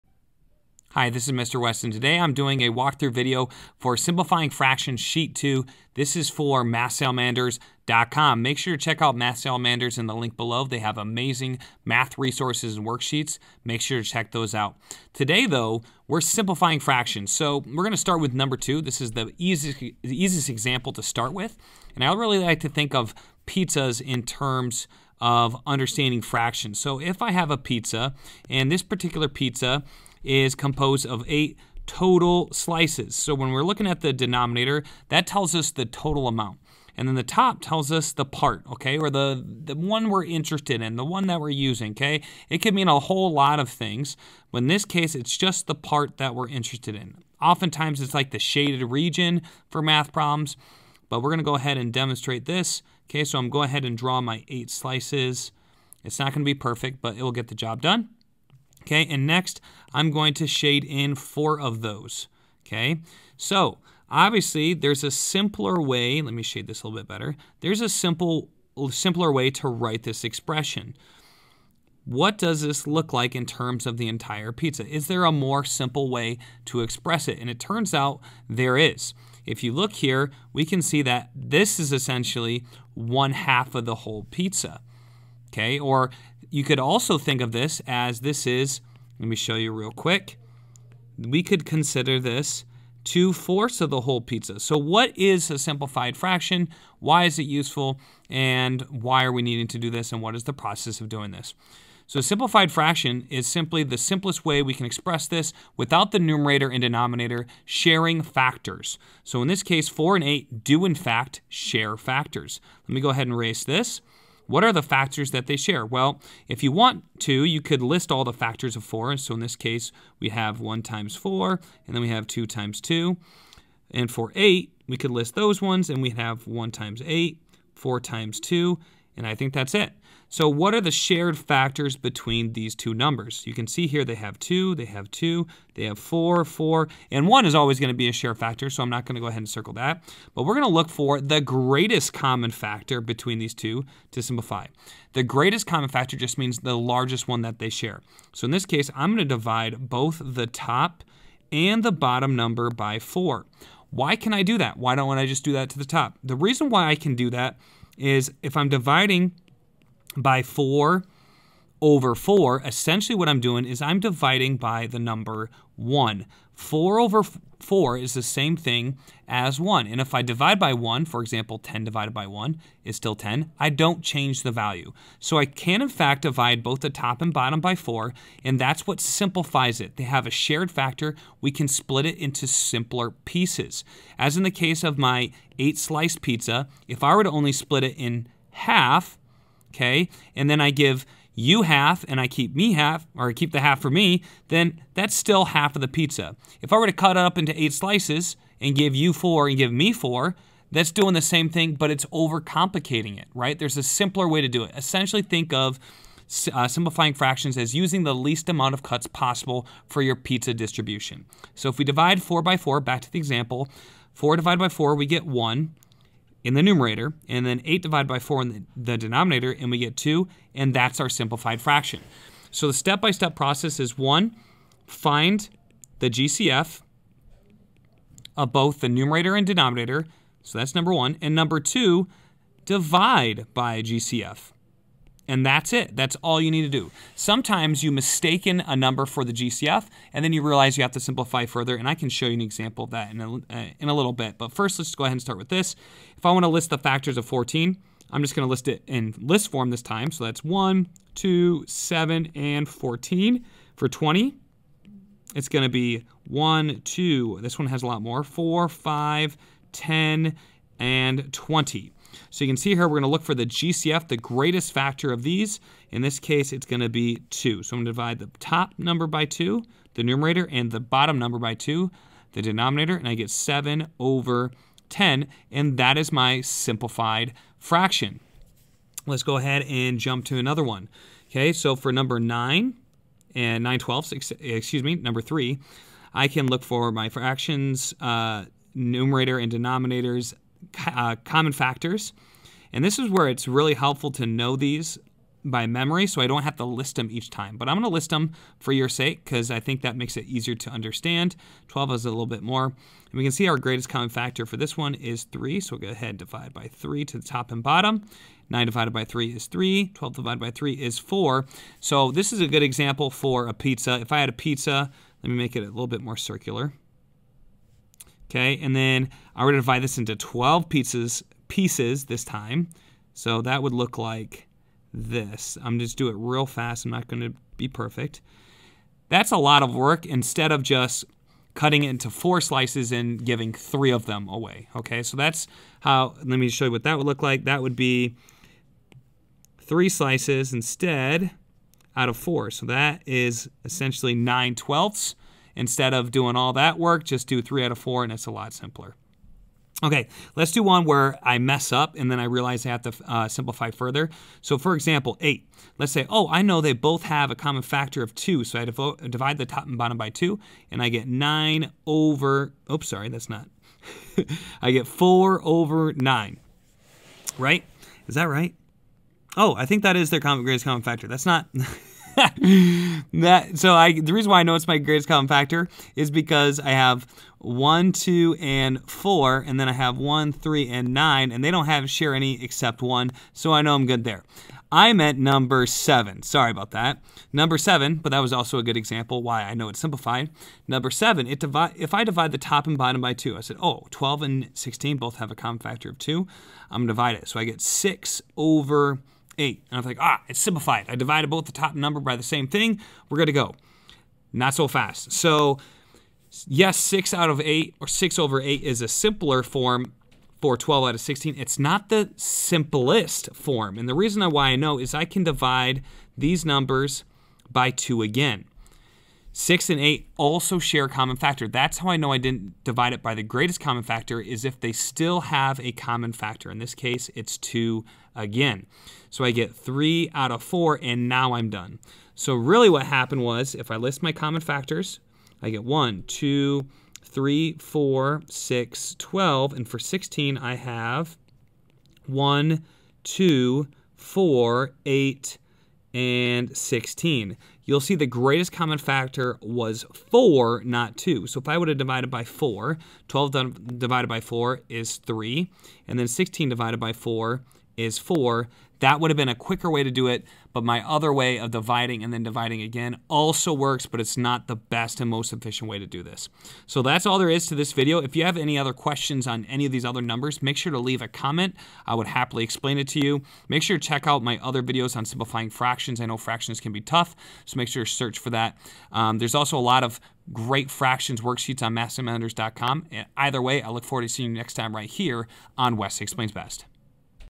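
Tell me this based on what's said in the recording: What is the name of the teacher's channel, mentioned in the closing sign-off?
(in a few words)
West Explains Best.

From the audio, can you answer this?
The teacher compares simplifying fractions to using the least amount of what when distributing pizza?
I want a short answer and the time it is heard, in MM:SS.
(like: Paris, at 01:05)
cuts, at 03:28.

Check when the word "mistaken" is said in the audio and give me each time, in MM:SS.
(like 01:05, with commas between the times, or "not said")
03:57.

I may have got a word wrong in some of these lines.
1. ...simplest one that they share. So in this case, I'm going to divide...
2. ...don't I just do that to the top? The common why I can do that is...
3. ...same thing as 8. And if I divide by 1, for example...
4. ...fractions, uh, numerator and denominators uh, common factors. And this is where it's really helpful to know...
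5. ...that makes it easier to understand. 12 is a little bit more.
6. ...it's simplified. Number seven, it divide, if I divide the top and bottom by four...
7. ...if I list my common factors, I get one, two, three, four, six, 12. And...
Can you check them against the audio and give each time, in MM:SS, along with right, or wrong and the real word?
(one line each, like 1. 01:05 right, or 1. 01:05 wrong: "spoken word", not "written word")
1. 02:26 wrong: "largest", not "simplest"
2. 02:34 wrong: "reason", not "common"
3. 02:48 wrong: "1", not "8"
4. 04:47 right
5. 04:59 right
6. 06:29 wrong: "two", not "four"
7. 07:13 right.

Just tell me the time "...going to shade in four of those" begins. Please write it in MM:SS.
01:00.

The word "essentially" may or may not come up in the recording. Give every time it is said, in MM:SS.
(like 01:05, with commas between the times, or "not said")
01:21, 02:42, 03:24, 05:43.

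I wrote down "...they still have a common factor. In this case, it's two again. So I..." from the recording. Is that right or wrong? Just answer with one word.
right.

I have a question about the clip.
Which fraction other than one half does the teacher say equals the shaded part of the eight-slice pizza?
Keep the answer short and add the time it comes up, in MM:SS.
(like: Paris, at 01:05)
two fourths, at 01:33.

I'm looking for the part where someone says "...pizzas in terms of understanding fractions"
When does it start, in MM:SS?
00:23.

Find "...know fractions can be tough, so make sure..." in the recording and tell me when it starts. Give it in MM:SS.
07:56.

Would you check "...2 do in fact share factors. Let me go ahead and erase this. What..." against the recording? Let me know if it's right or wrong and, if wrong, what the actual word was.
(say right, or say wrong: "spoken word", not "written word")
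wrong: "8", not "2".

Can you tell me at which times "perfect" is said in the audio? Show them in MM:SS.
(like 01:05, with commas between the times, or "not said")
00:56, 05:27.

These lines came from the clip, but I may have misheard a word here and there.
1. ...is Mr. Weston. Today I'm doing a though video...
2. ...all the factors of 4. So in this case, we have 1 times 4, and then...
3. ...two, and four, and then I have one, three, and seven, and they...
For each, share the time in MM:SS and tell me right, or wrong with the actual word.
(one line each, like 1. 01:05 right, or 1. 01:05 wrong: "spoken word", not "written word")
1. 00:01 wrong: "walkthrough", not "though"
2. 01:58 right
3. 06:17 wrong: "nine", not "seven".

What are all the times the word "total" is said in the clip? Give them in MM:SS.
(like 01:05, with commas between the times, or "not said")
00:31, 00:35.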